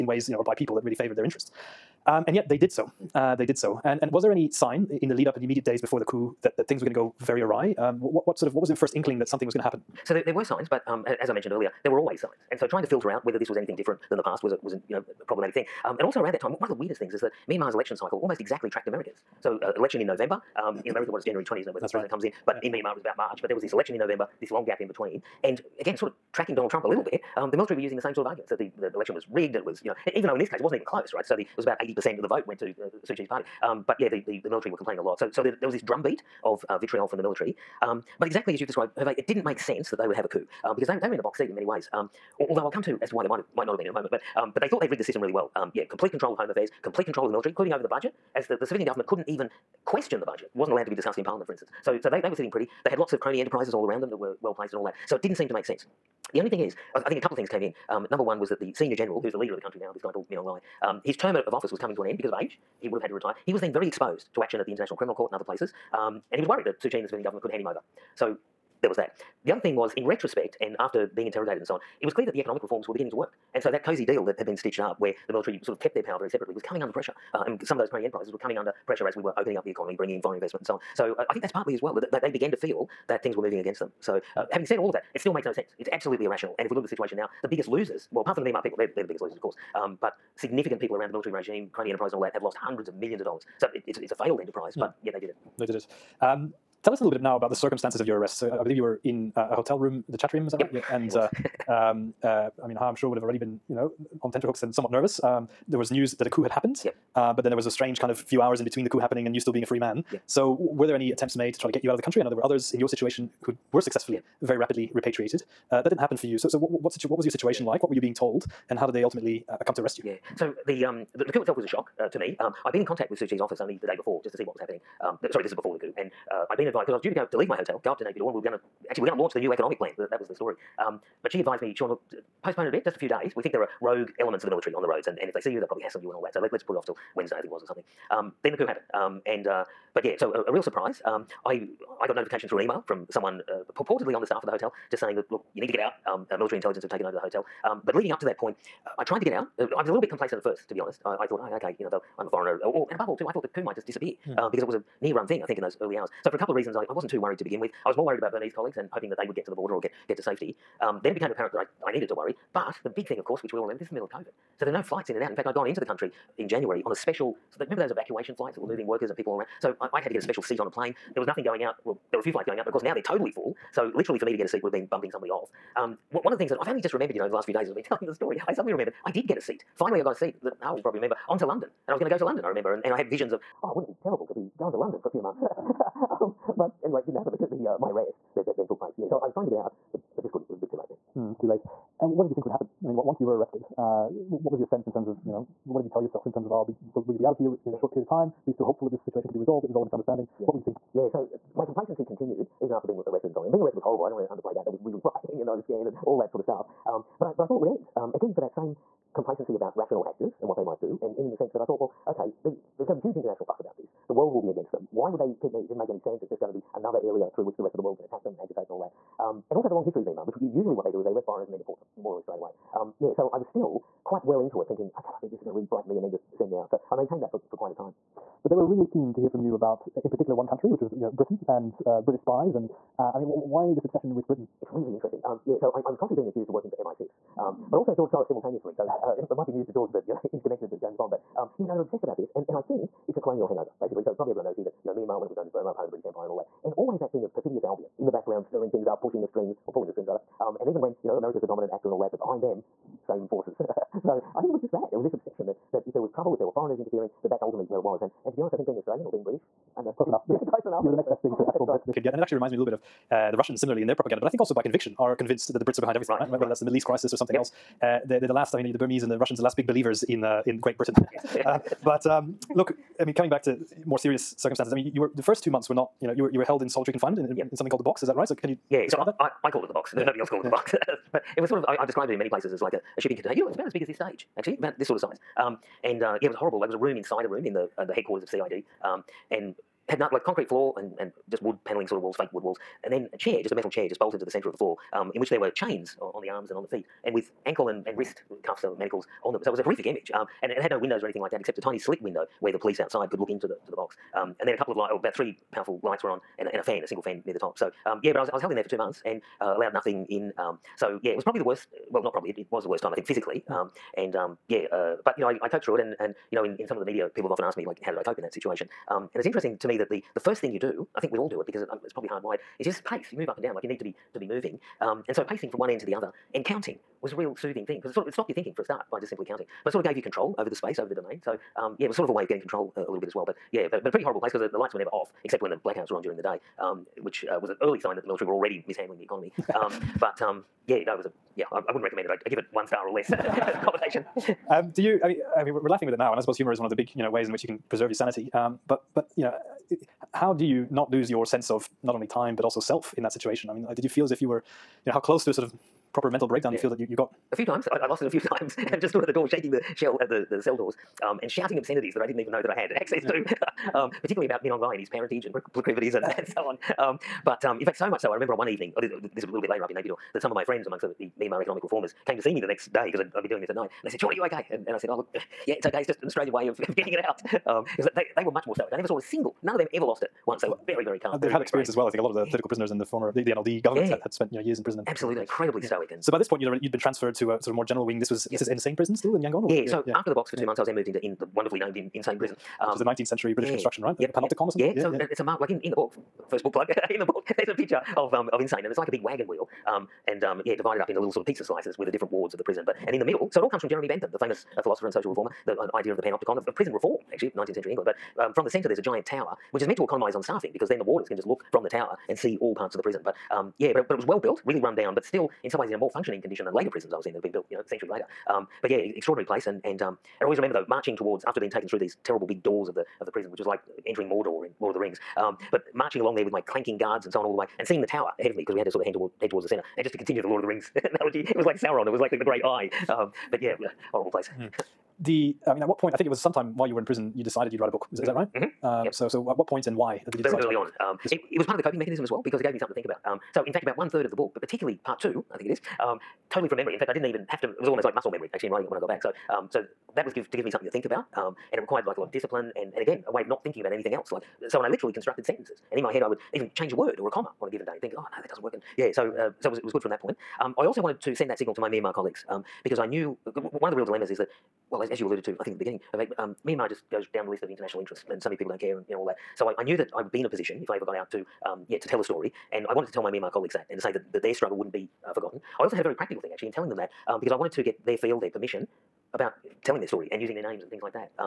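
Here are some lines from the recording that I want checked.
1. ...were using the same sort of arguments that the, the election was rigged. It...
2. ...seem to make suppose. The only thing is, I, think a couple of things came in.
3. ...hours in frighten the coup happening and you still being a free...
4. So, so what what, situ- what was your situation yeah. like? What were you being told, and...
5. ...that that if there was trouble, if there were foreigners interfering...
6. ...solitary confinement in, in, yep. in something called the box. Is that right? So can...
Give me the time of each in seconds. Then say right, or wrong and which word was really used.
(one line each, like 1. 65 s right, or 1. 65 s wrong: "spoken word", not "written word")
1. 27 s right
2. 55 s wrong: "sense", not "suppose"
3. 108 s wrong: "between", not "frighten"
4. 116 s right
5. 255 s right
6. 276 s right.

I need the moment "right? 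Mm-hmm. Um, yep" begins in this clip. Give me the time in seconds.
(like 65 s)
438 s.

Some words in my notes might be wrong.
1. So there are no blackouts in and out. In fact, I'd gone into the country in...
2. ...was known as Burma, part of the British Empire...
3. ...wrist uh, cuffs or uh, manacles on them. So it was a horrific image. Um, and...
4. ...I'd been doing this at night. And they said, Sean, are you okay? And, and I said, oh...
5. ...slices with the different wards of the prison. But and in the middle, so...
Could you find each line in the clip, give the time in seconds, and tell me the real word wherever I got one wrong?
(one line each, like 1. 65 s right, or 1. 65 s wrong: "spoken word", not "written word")
1. 164 s wrong: "flights", not "blackouts"
2. 245 s right
3. 297 s right
4. 373 s right
5. 401 s right.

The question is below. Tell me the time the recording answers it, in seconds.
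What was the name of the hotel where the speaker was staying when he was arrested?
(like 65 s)
100 s.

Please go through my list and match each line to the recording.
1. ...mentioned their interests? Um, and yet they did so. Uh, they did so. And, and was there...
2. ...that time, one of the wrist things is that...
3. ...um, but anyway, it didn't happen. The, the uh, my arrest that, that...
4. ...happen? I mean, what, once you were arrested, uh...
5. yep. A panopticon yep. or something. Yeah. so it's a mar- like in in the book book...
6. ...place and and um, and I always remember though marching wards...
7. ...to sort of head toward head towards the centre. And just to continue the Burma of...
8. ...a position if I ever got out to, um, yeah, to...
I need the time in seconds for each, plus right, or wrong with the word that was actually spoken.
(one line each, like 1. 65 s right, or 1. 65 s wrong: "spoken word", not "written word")
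1. 0 s wrong: "favored", not "mentioned"
2. 16 s wrong: "weirdest", not "wrist"
3. 186 s right
4. 192 s right
5. 393 s right
6. 419 s wrong: "towards", not "wards"
7. 428 s wrong: "Lord", not "Burma"
8. 470 s right.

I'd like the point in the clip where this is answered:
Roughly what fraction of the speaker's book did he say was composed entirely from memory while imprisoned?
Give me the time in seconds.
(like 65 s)
443 s.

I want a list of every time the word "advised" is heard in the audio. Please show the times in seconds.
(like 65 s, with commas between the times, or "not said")
126 s, 131 s.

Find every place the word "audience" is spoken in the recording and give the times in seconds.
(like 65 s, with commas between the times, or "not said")
not said.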